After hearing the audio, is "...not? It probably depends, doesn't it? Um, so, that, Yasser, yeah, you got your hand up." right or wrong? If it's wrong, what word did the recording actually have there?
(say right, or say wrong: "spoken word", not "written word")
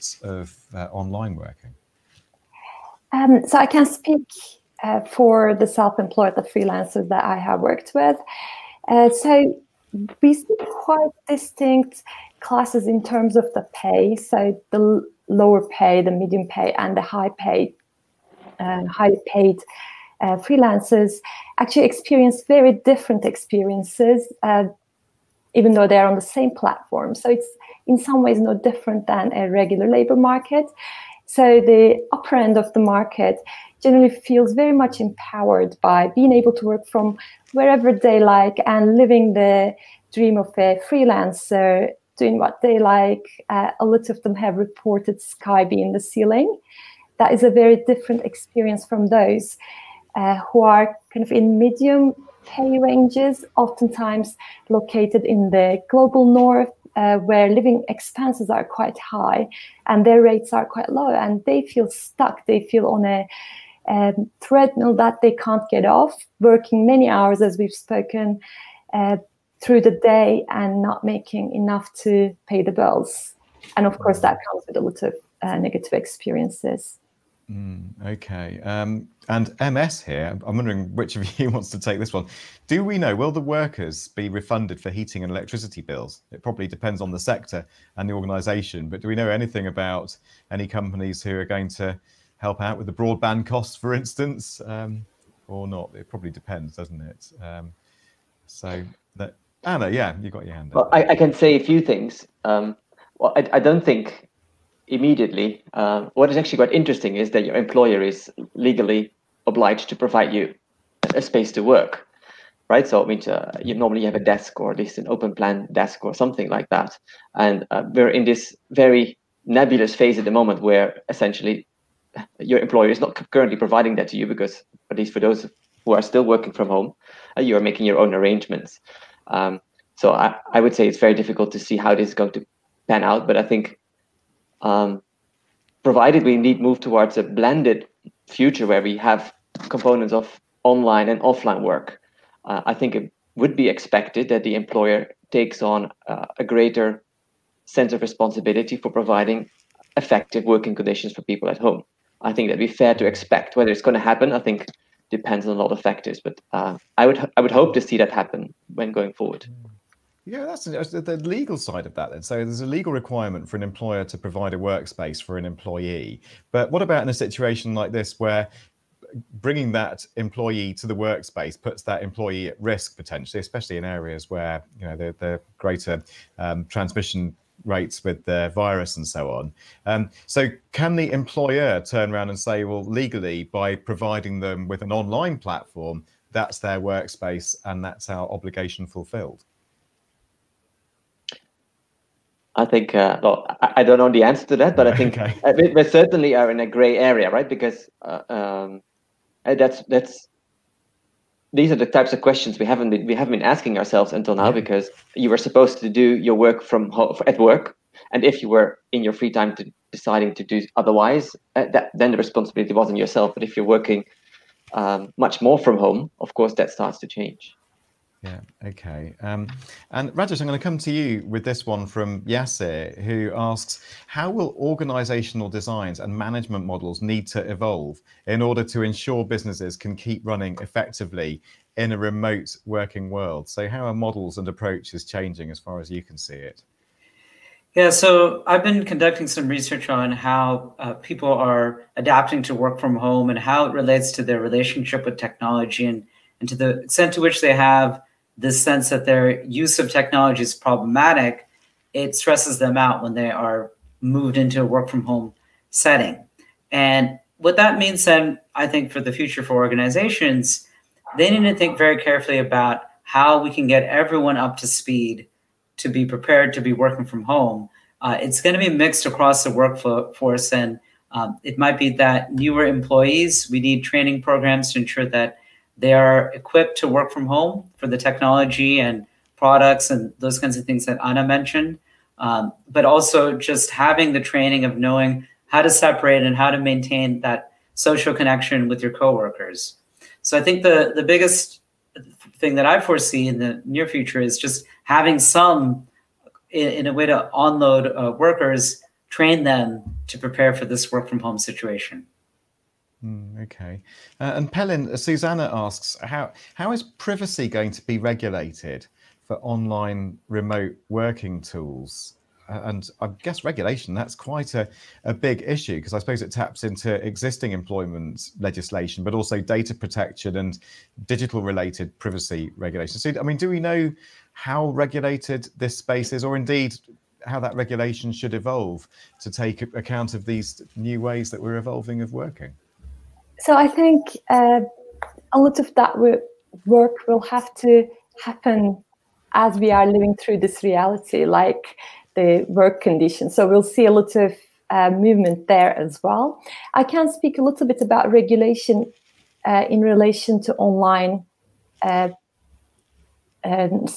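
wrong: "Anna", not "Yasser".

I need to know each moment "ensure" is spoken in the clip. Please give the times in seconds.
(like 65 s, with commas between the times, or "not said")
228 s, 274 s.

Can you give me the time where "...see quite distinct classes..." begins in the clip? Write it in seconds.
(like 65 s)
10 s.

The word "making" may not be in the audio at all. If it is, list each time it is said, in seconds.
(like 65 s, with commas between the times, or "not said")
71 s, 127 s.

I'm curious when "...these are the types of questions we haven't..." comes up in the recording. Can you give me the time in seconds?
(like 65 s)
201 s.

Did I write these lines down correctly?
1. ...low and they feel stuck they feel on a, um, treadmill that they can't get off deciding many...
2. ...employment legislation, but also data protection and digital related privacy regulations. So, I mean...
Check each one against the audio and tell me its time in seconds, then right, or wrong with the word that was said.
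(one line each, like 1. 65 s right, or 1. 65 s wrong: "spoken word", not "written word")
1. 60 s wrong: "working", not "deciding"
2. 317 s right.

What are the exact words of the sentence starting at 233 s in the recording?
So, how are models and approaches changing as far as you can see it?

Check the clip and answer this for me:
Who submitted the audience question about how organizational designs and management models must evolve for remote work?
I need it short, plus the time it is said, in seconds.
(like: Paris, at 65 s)
Yasser, at 222 s.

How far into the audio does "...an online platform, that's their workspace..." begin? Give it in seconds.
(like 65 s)
184 s.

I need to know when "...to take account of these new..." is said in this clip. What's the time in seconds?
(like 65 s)
329 s.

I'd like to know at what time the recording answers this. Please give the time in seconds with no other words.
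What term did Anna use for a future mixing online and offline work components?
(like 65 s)
137 s.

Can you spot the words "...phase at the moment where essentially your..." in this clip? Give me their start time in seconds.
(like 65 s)
119 s.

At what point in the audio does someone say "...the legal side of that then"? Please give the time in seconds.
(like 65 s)
160 s.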